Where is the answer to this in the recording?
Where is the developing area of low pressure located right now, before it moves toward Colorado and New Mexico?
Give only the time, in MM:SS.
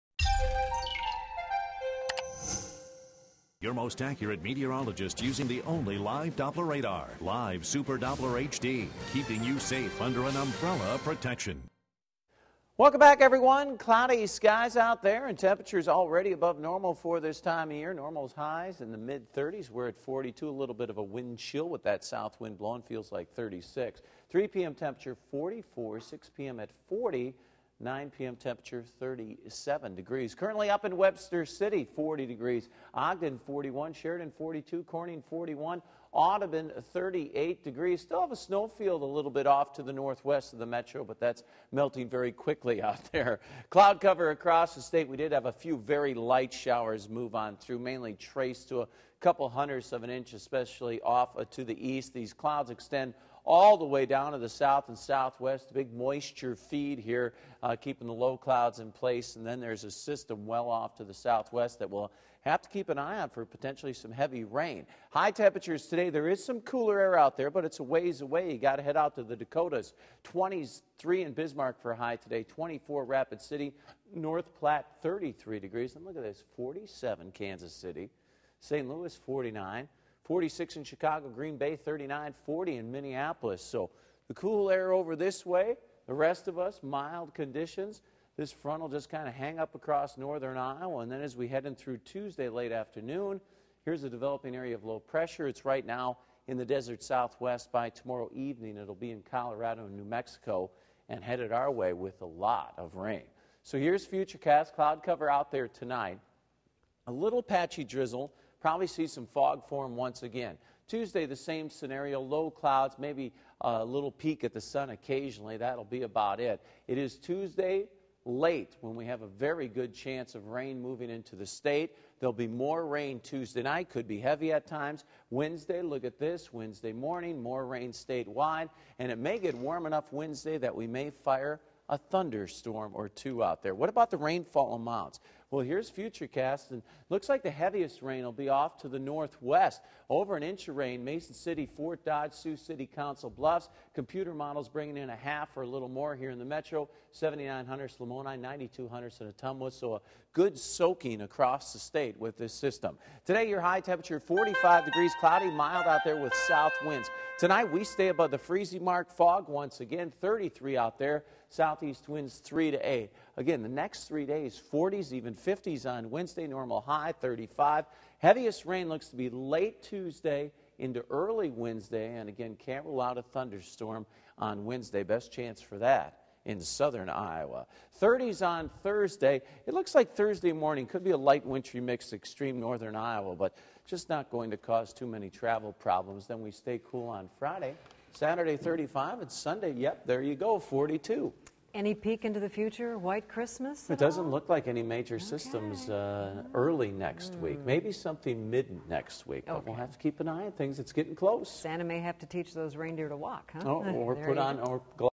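01:36.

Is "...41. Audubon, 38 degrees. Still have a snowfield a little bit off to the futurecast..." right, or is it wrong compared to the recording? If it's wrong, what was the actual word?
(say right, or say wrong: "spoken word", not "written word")
wrong: "northwest", not "futurecast".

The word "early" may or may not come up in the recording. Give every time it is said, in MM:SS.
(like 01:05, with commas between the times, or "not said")
02:51, 03:16.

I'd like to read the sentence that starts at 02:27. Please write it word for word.
7900 Hunters, Lamoni, 92 Hunters, and Ottumwa.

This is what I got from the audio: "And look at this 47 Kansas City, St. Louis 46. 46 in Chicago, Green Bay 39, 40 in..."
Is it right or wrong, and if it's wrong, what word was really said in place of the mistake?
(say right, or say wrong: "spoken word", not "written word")
wrong: "49", not "46".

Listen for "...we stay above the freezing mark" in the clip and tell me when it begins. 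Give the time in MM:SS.
02:37.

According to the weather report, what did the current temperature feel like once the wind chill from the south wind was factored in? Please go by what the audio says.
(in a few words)
36.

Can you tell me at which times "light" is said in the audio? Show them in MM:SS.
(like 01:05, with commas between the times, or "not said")
00:46, 03:01.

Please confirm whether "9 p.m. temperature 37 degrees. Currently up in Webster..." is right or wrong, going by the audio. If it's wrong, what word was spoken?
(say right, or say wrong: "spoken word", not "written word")
right.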